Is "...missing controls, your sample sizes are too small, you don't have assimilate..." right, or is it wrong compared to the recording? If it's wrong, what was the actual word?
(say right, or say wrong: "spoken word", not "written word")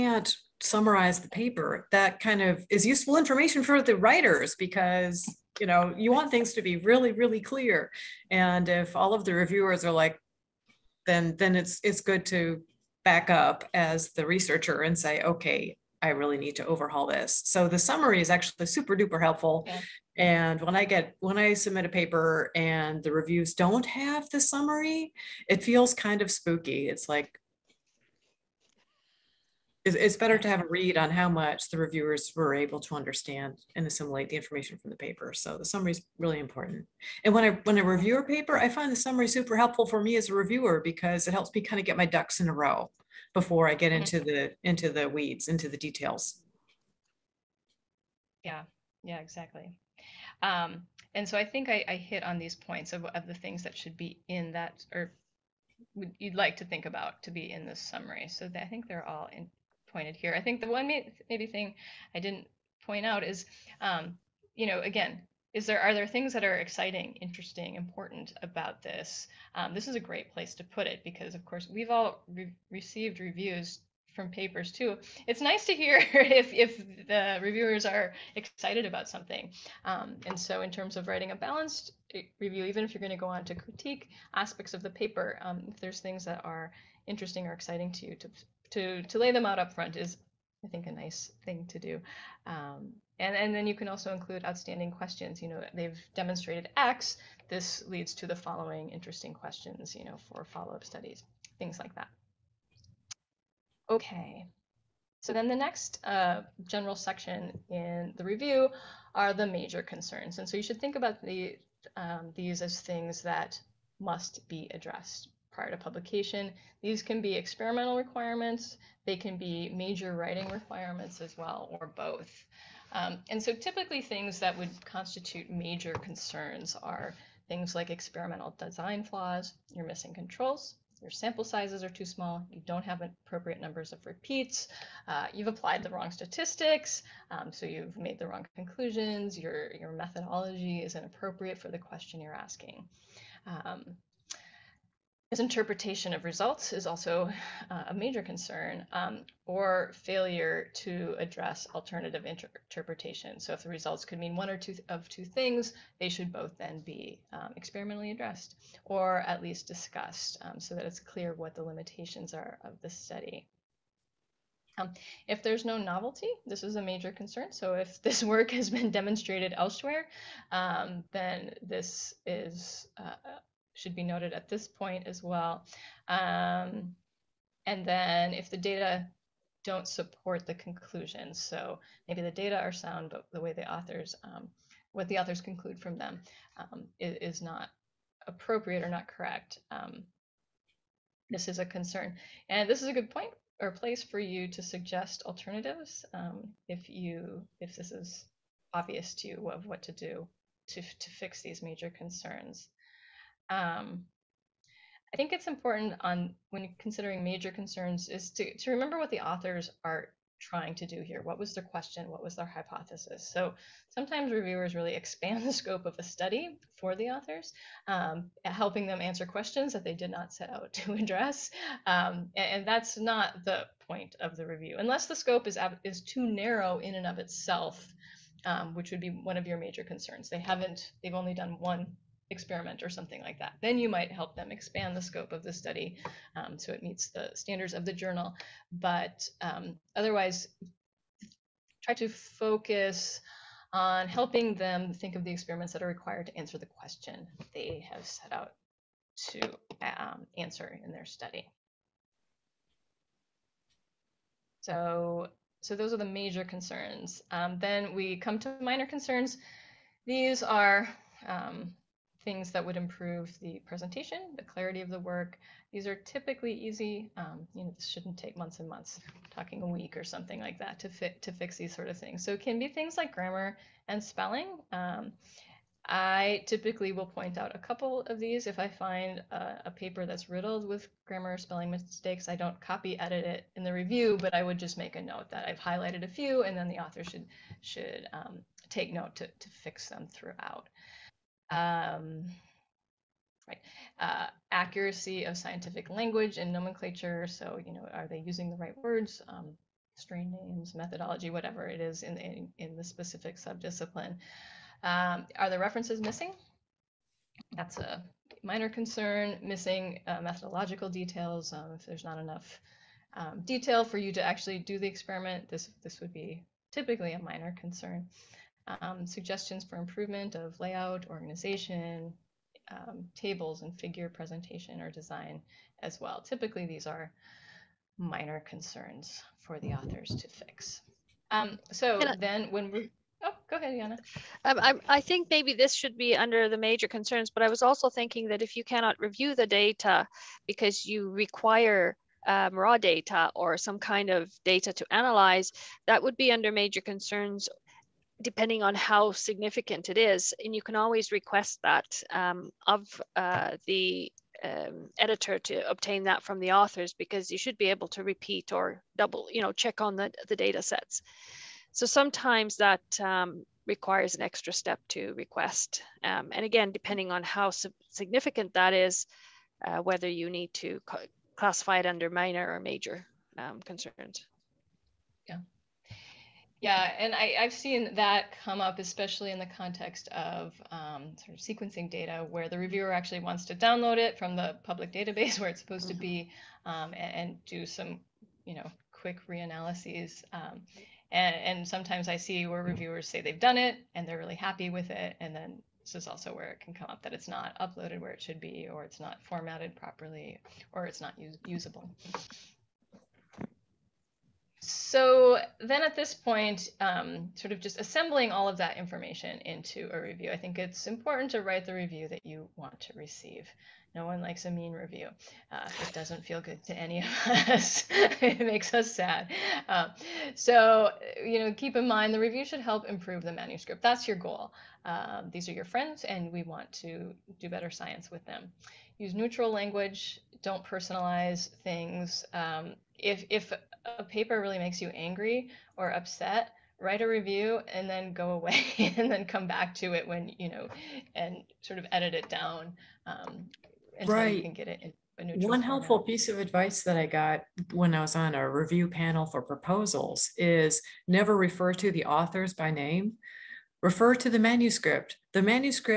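wrong: "appropriate", not "assimilate".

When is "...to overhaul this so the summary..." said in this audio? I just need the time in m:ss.
0:16.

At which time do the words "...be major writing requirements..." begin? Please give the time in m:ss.
1:59.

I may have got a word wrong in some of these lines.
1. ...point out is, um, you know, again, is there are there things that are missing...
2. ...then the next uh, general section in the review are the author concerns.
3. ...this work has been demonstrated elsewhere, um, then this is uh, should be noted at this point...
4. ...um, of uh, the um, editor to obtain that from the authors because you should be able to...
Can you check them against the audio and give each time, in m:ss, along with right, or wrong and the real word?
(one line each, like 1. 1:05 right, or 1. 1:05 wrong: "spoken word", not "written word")
1. 1:02 wrong: "exciting", not "missing"
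2. 1:45 wrong: "major", not "author"
3. 2:48 right
4. 5:52 right.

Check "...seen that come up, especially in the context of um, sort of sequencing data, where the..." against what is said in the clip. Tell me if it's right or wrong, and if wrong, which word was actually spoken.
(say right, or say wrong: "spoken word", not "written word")
right.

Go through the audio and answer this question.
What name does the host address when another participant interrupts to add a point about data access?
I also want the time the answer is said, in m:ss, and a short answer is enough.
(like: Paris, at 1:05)
Yana, at 5:33.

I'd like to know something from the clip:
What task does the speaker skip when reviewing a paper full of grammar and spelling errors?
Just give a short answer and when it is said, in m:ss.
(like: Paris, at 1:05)
copy edit it, at 4:42.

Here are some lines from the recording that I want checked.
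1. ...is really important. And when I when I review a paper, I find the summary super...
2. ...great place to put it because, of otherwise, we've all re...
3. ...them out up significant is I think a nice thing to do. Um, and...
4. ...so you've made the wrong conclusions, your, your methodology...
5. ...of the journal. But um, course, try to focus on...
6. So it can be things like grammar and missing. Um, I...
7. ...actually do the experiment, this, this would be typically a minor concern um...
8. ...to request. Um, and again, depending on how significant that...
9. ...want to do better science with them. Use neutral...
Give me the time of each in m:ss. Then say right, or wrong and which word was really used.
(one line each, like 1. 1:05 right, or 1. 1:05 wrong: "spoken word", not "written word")
1. 0:35 right
2. 1:09 wrong: "course", not "otherwise"
3. 1:29 wrong: "front", not "significant"
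4. 2:17 right
5. 3:57 wrong: "otherwise", not "course"
6. 4:32 wrong: "spelling", not "missing"
7. 5:14 right
8. 6:04 right
9. 7:06 right.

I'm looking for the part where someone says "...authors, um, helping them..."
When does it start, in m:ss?
3:37.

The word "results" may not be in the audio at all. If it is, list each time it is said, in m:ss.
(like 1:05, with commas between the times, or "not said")
2:26, 2:33.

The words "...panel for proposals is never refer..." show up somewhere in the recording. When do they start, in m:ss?
7:28.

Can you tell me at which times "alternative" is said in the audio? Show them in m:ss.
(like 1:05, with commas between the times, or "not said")
2:31, 3:15.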